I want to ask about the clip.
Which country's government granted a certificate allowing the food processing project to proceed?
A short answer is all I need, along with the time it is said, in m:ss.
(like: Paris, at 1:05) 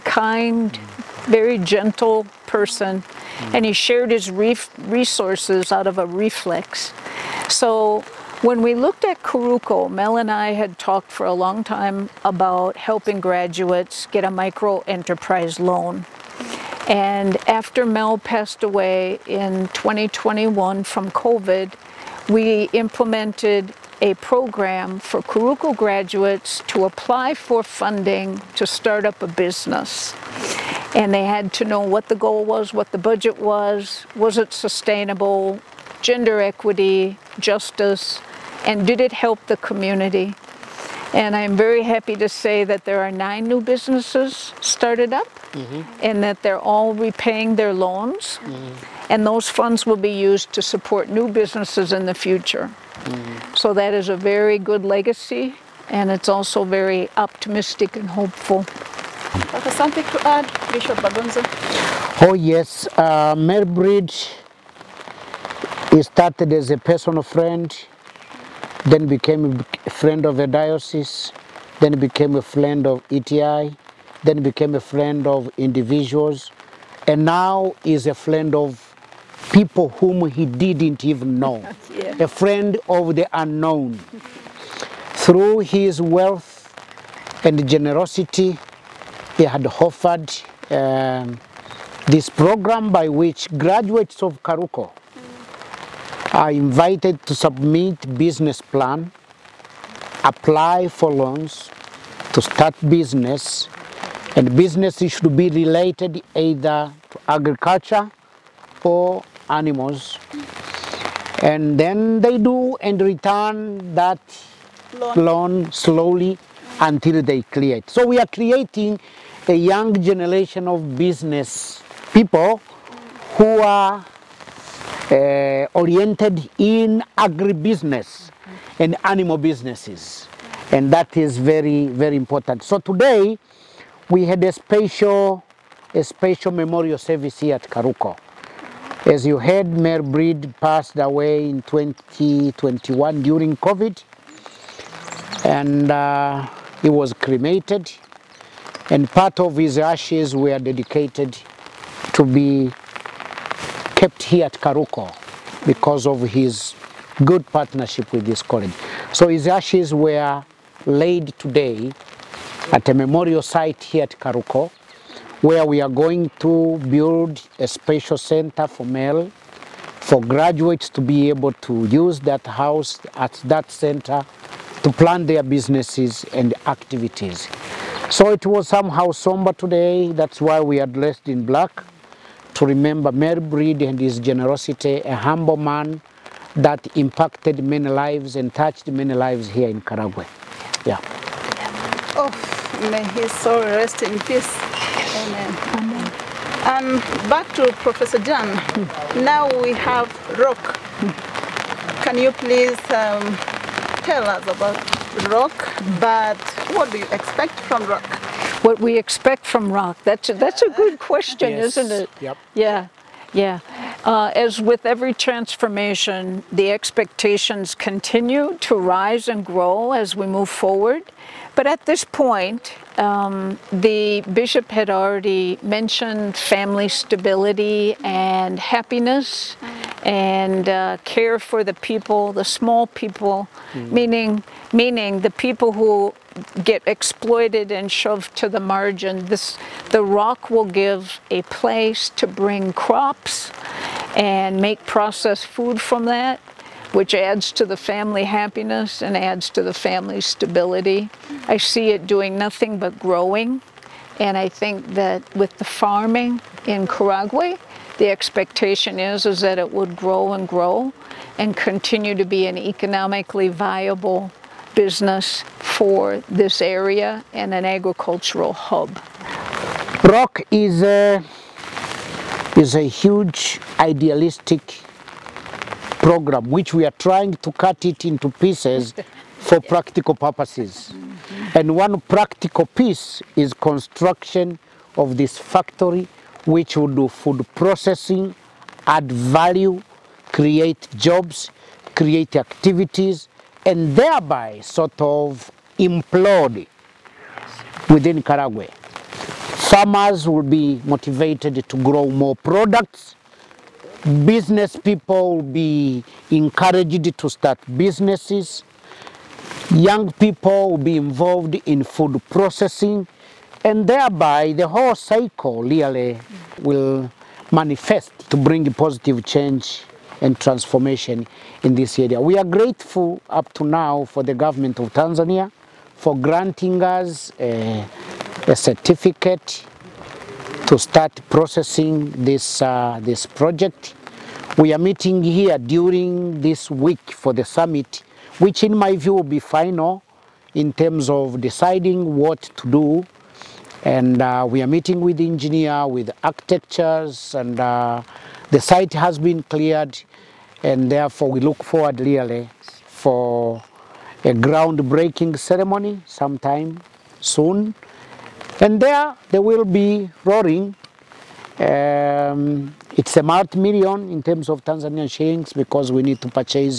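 Tanzania, at 5:24.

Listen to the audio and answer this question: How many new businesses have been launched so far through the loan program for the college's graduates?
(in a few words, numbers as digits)
9.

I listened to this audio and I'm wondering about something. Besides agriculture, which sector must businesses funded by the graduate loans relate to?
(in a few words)
Animals.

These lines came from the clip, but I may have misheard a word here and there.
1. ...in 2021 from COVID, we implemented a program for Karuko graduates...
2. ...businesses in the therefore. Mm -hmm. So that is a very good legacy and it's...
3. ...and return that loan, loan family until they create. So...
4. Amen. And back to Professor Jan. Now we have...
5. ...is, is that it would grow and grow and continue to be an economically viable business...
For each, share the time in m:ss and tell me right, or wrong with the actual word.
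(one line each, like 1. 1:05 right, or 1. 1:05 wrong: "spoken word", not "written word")
1. 0:19 right
2. 0:51 wrong: "future", not "therefore"
3. 1:52 wrong: "slowly", not "family"
4. 3:15 right
5. 4:18 right.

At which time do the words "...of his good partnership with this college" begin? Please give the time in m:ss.
2:36.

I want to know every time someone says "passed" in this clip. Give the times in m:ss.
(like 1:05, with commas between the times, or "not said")
0:18, 2:20.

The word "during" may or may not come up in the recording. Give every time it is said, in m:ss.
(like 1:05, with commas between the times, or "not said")
2:23, 5:35.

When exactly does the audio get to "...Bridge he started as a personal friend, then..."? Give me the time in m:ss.
1:03.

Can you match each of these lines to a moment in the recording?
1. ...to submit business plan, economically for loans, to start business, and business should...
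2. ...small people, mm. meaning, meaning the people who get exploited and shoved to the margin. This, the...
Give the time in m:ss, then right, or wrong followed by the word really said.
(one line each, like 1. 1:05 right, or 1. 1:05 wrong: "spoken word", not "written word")
1. 1:37 wrong: "apply", not "economically"
2. 3:52 right.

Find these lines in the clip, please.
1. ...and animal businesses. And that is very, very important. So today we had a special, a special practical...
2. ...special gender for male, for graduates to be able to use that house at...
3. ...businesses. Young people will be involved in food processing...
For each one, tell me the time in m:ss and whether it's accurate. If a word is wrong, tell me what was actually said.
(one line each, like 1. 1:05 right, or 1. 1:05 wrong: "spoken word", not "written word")
1. 2:08 wrong: "memorial", not "practical"
2. 2:47 wrong: "center", not "gender"
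3. 5:07 right.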